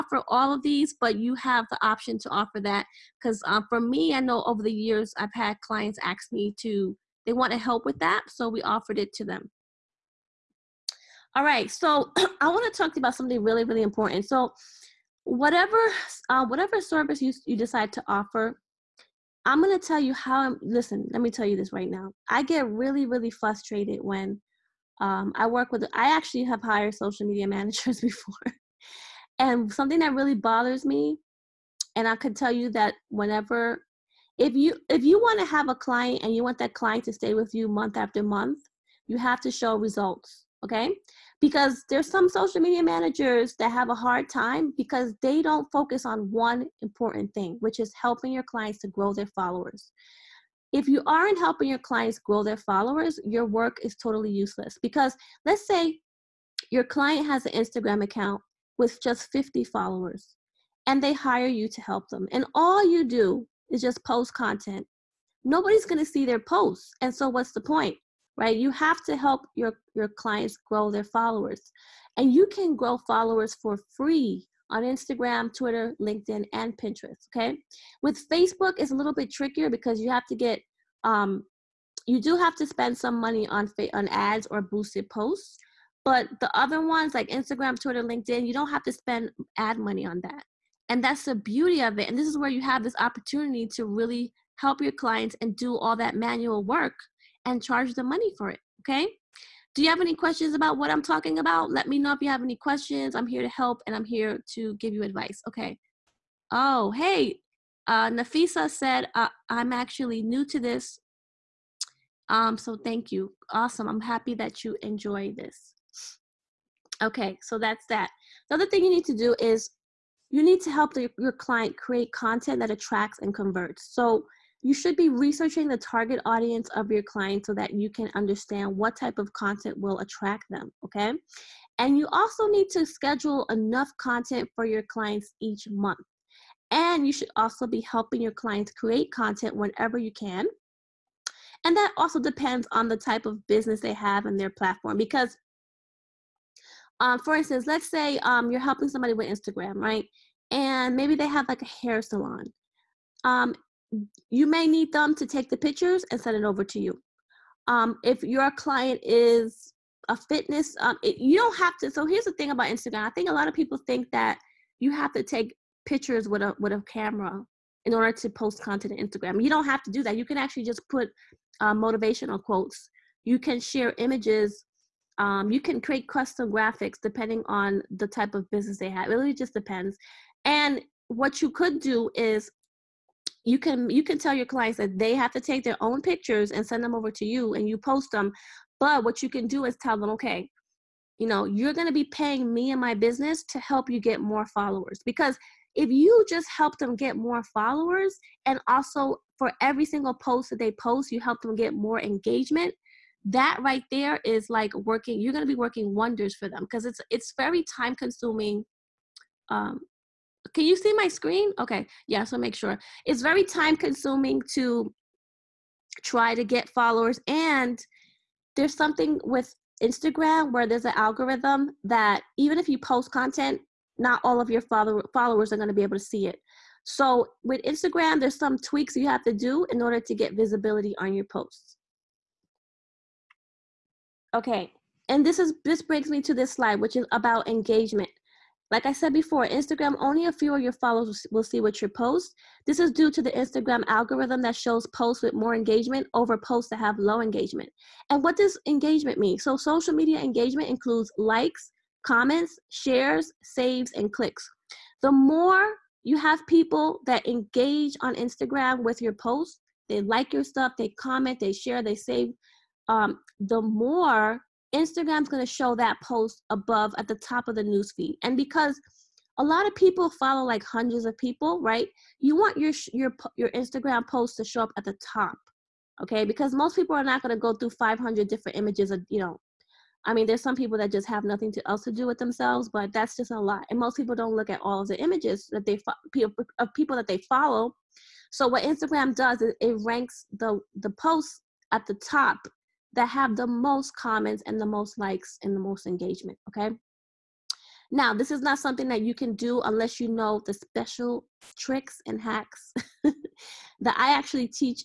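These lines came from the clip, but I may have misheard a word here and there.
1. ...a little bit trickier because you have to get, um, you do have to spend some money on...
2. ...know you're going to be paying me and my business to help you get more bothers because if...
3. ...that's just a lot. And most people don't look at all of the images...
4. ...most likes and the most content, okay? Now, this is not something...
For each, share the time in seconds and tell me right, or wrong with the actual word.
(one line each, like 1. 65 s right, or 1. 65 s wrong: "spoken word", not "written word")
1. 78 s right
2. 191 s wrong: "followers", not "bothers"
3. 282 s right
4. 294 s wrong: "engagement", not "content".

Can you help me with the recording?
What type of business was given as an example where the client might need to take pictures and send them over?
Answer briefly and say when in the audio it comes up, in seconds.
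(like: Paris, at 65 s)
hair salon, at 151 s.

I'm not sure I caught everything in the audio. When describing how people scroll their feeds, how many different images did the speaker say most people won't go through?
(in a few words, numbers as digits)
500.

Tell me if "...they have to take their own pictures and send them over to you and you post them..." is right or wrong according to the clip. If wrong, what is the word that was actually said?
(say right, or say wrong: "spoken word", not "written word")
right.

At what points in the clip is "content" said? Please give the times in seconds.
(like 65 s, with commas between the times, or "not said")
64 s, 122 s, 129 s, 133 s, 139 s, 168 s, 223 s.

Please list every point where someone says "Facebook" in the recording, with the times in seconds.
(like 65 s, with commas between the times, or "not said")
78 s.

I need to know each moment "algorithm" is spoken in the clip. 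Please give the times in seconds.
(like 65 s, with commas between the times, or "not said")
220 s, 243 s.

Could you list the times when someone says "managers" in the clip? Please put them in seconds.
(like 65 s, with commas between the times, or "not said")
27 s, 42 s.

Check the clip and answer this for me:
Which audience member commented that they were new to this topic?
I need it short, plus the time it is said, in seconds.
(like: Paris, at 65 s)
Nafisa, at 108 s.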